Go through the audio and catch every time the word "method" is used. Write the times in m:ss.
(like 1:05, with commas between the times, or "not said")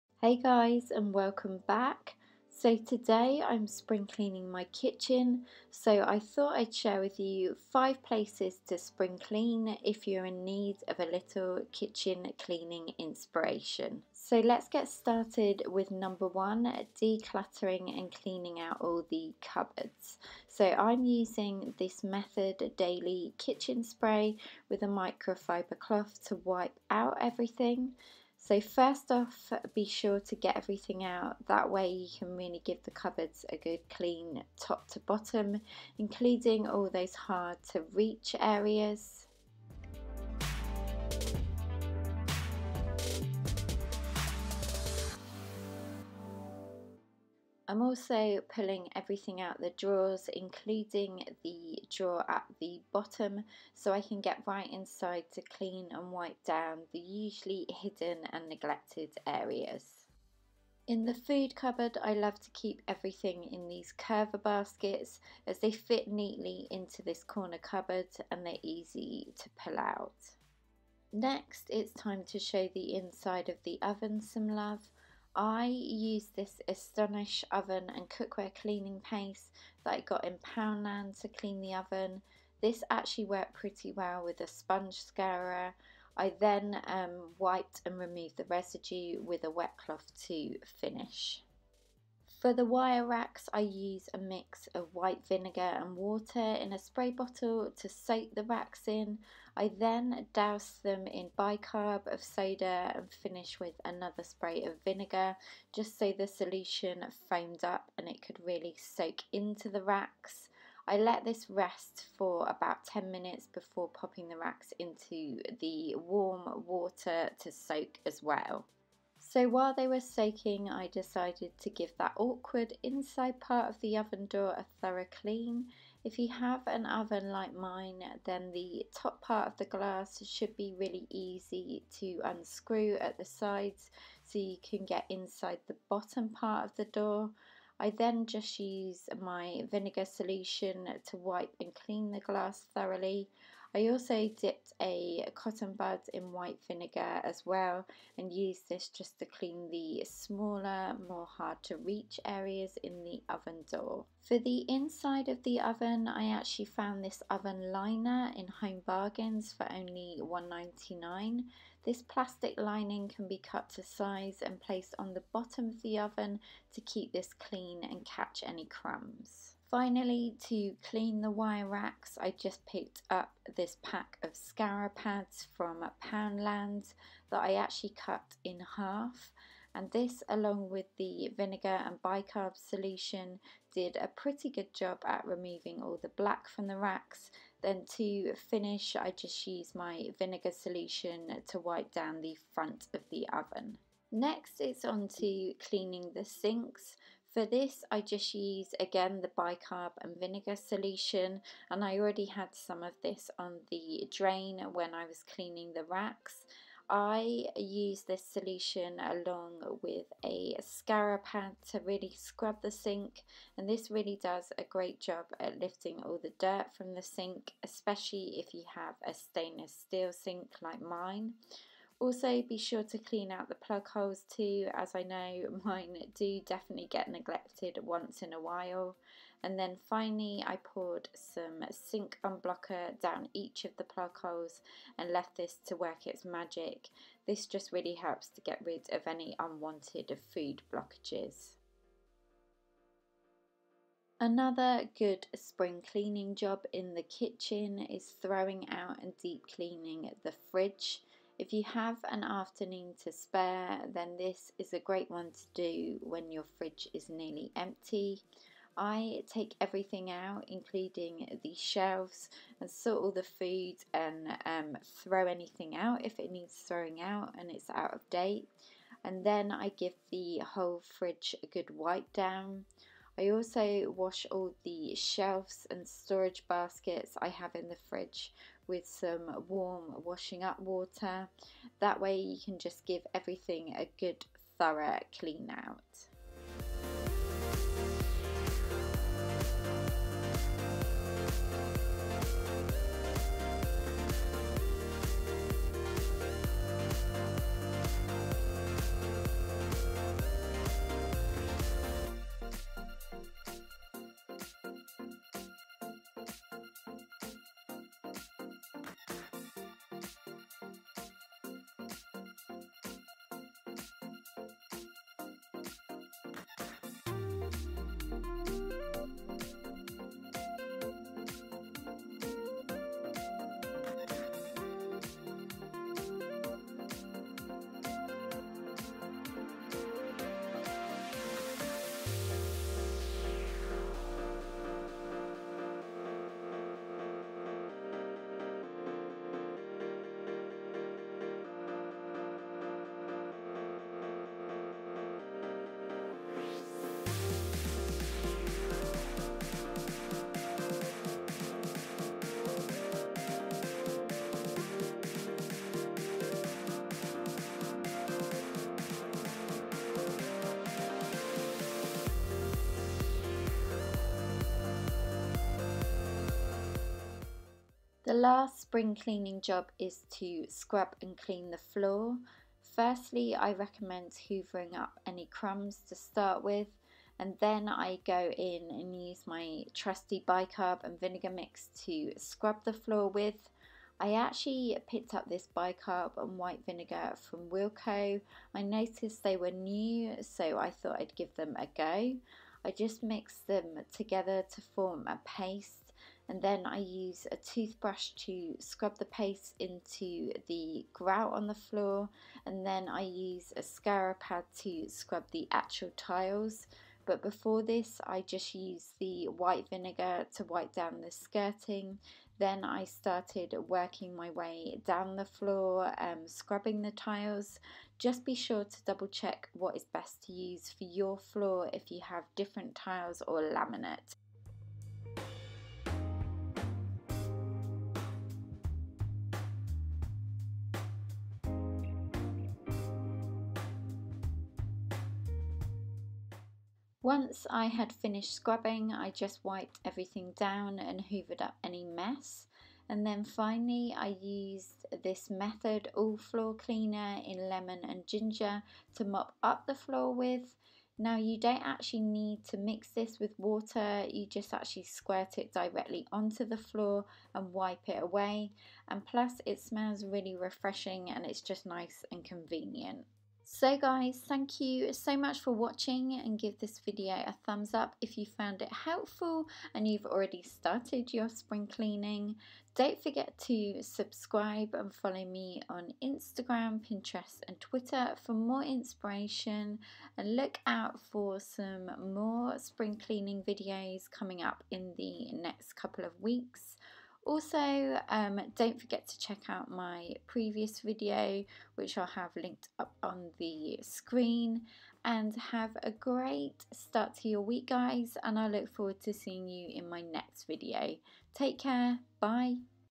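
0:22, 7:25.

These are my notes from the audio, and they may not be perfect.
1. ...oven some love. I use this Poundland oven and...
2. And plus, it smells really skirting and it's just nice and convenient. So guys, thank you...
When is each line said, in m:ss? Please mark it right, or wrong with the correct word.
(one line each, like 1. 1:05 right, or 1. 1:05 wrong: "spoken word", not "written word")
1. 1:13 wrong: "Astonish", not "Poundland"
2. 7:38 wrong: "refreshing", not "skirting".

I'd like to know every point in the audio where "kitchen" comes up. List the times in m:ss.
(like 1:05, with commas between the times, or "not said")
0:04, 0:11, 0:23, 4:07.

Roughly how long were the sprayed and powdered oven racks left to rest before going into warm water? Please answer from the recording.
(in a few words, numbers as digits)
10 minutes.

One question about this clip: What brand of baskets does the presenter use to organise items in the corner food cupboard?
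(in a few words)
Curver.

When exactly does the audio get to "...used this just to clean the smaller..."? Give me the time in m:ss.
2:28.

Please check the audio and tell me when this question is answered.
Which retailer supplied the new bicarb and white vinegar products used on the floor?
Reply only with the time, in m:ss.
6:27.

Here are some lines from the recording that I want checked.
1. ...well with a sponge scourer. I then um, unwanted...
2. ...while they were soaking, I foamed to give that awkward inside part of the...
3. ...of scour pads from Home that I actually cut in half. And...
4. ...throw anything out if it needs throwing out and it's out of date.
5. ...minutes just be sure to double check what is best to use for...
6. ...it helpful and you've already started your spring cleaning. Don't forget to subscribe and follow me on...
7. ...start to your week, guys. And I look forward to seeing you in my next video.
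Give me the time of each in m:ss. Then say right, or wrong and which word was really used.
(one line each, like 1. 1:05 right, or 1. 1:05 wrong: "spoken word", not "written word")
1. 1:23 wrong: "wiped", not "unwanted"
2. 1:59 wrong: "decided", not "foamed"
3. 2:54 wrong: "Poundland", not "Home"
4. 4:24 right
5. 6:56 wrong: "tiles", not "minutes"
6. 7:48 right
7. 8:16 right.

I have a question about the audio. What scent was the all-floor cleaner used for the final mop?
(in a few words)
Lemon and ginger.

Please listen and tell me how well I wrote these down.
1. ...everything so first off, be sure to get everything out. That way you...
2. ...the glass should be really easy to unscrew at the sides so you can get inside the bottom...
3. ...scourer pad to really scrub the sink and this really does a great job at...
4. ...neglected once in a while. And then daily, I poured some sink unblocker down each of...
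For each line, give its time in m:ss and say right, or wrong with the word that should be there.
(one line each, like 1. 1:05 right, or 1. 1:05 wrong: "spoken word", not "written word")
1. 0:27 right
2. 2:09 right
3. 3:30 right
4. 3:47 wrong: "finally", not "daily".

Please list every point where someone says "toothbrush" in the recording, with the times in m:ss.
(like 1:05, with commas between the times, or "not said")
6:37.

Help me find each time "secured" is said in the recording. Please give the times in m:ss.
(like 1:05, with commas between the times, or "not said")
not said.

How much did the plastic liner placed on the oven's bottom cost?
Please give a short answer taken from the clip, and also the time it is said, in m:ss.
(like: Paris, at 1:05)
$1.99, at 2:40.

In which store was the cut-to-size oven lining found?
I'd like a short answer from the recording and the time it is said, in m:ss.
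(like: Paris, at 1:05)
Home Bargains, at 2:38.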